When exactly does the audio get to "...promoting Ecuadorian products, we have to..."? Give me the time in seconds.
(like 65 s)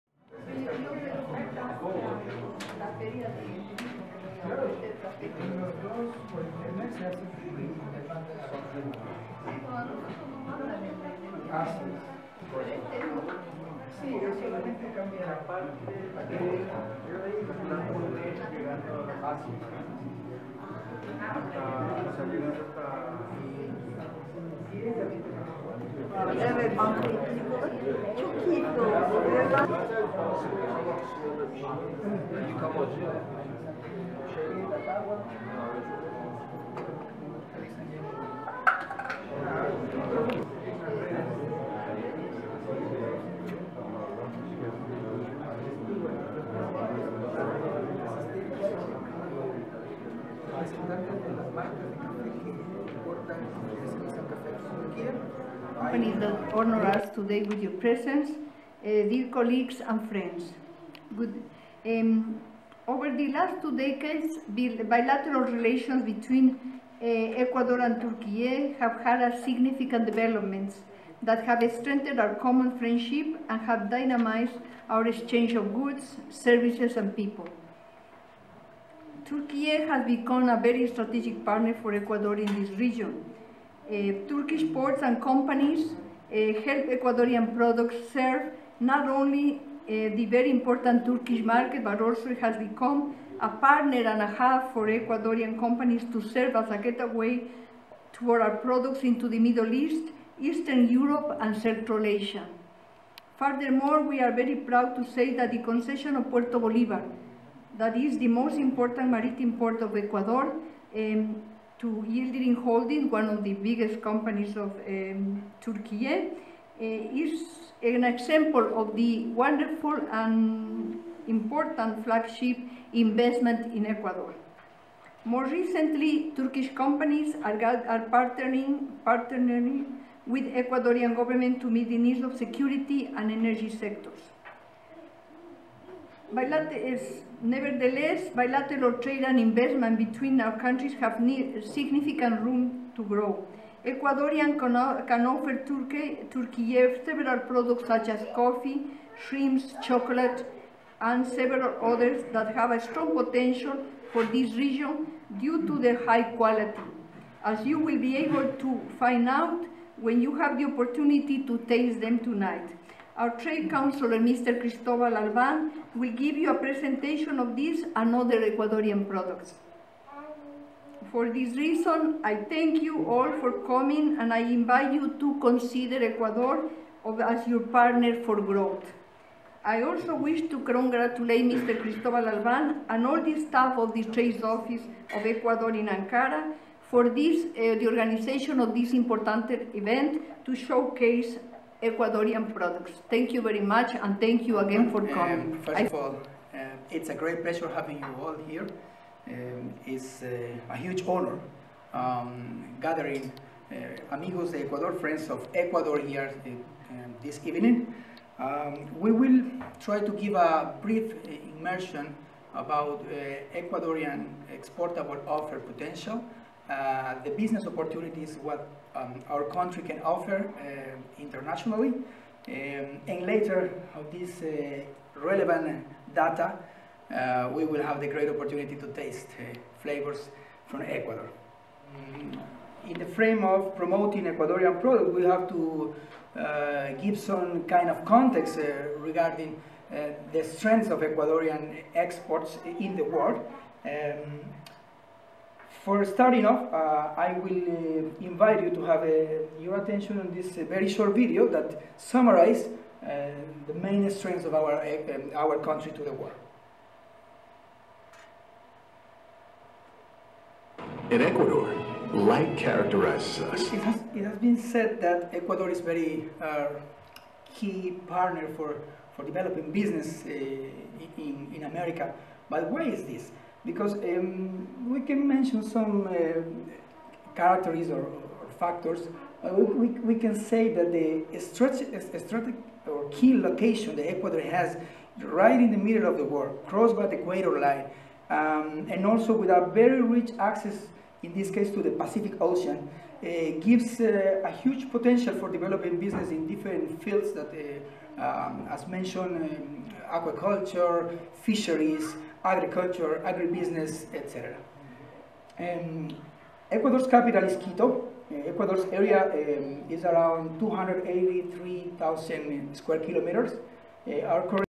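233 s.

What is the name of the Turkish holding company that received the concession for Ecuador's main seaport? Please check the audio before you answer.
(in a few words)
Yildirim Holding.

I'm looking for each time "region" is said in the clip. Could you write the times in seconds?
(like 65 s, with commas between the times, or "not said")
82 s, 154 s.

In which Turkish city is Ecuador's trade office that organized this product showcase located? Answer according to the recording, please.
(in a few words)
Ankara.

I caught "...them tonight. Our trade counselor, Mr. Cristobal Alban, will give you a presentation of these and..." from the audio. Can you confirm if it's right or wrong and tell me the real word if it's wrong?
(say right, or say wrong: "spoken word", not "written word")
right.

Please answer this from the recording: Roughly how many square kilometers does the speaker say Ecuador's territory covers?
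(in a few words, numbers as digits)
283,000.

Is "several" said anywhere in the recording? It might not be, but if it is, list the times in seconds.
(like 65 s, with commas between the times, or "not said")
147 s, 151 s.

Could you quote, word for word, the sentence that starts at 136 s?
Bilater nevertheless, bilateral trade and investment between our countries have significant room to grow.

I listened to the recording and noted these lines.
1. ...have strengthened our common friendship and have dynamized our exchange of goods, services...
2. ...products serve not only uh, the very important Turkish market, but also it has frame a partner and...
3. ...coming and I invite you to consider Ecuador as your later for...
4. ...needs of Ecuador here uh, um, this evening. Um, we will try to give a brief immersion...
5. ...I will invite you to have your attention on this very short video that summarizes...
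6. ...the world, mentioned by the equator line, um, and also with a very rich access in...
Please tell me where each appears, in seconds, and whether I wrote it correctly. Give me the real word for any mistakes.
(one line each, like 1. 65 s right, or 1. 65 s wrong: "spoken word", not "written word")
1. 71 s right
2. 87 s wrong: "become", not "frame"
3. 173 s wrong: "partner", not "later"
4. 204 s wrong: "friends", not "needs"
5. 247 s right
6. 286 s wrong: "crossed", not "mentioned".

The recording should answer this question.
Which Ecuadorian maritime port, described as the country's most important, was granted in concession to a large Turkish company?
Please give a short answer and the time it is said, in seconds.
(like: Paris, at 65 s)
Puerto Bolívar, at 106 s.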